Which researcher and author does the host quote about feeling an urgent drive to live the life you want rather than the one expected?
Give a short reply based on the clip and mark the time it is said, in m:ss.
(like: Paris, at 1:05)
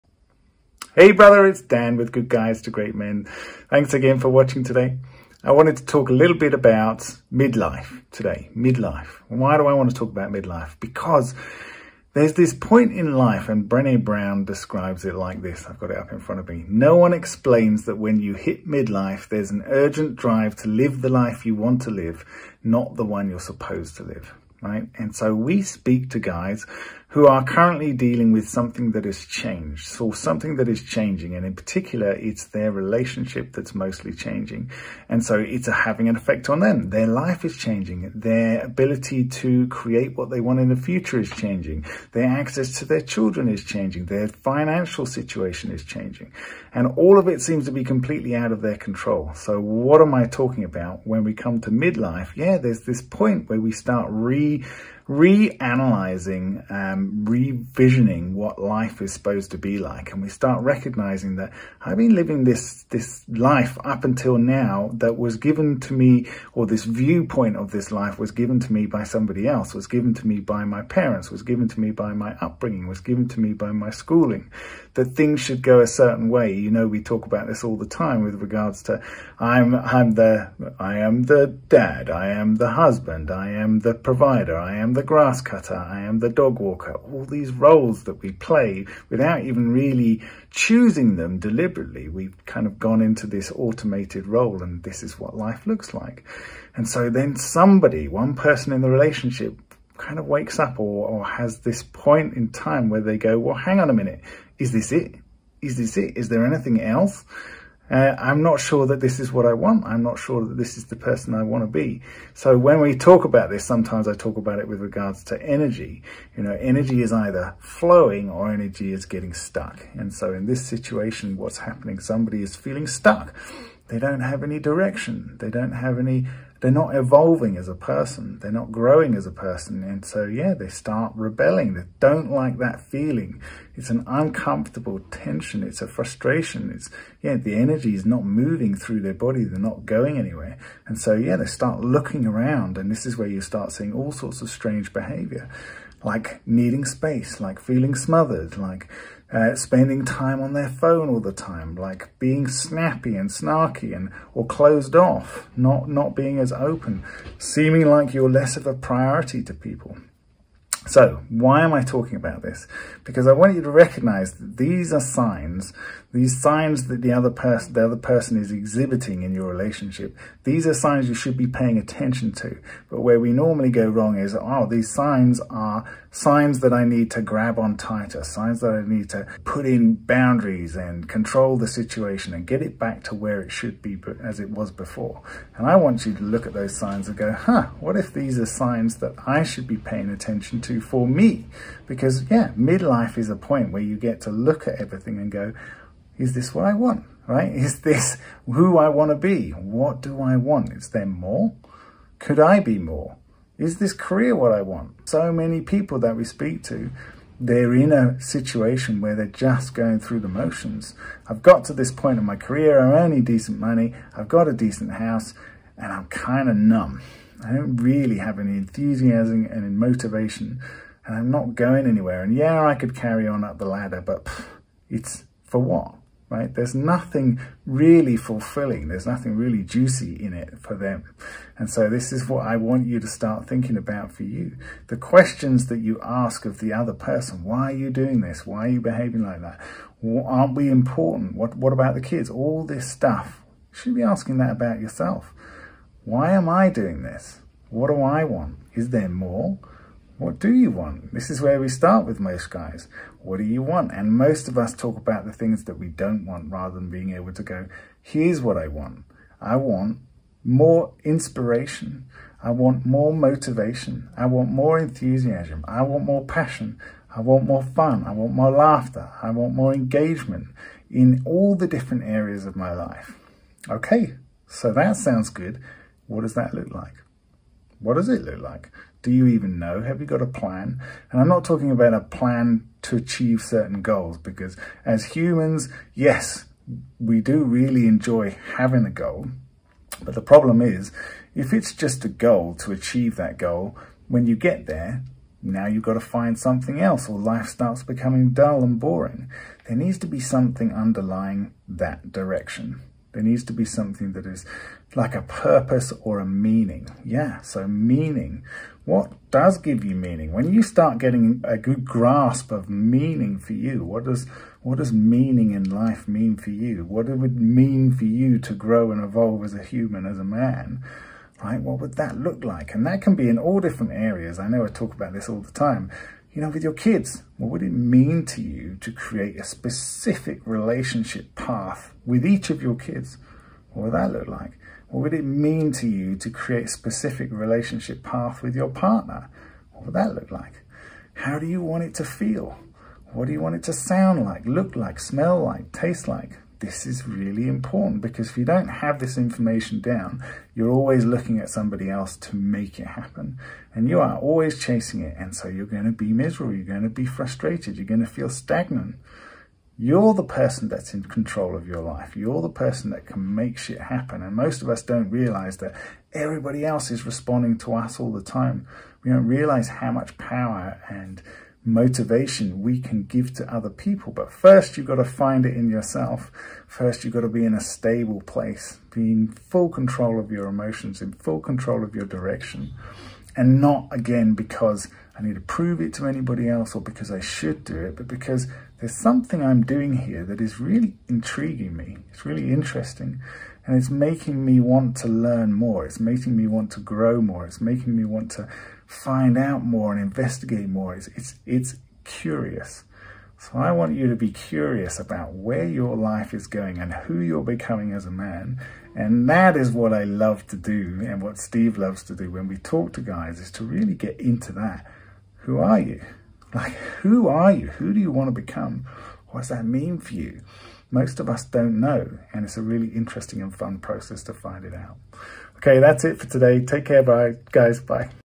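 Brené Brown, at 0:13.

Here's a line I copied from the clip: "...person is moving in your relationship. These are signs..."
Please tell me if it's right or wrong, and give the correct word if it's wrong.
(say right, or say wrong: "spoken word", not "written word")
wrong: "exhibiting", not "moving".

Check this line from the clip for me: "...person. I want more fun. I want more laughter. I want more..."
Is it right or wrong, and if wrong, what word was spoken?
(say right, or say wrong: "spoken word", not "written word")
wrong: "passion", not "person".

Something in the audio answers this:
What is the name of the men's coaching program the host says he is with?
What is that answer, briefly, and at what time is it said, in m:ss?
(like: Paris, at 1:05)
Good Guys to Great Men, at 0:02.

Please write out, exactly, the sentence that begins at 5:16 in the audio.
What it would mean for you to grow and evolve as a human, as a man?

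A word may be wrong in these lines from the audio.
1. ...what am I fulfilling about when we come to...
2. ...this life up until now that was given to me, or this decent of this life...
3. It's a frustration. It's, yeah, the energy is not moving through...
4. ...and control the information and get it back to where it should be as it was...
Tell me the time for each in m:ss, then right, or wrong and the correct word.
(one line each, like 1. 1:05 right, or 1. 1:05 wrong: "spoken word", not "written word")
1. 0:49 wrong: "talking", not "fulfilling"
2. 1:02 wrong: "viewpoint", not "decent"
3. 2:15 right
4. 3:00 wrong: "situation", not "information".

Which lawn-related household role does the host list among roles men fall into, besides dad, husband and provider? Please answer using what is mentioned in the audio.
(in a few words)
grass cutter.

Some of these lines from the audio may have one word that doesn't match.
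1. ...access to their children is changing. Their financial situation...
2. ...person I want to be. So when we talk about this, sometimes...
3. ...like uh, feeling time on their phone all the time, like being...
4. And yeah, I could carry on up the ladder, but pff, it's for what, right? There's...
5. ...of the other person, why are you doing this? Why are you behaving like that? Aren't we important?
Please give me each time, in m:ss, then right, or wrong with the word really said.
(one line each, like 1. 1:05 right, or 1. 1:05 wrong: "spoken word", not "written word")
1. 0:42 right
2. 1:50 right
3. 2:28 wrong: "spending", not "feeling"
4. 3:42 right
5. 3:56 right.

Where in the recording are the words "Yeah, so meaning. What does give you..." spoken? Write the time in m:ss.
5:07.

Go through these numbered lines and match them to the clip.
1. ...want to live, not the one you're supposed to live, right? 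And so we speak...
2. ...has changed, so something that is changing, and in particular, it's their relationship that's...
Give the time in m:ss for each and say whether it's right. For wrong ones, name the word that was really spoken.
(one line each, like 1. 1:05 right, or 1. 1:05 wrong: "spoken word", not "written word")
1. 0:21 right
2. 0:29 right.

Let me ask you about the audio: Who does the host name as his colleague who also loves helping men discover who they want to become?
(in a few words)
Steve.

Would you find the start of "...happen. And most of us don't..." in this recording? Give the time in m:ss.
6:03.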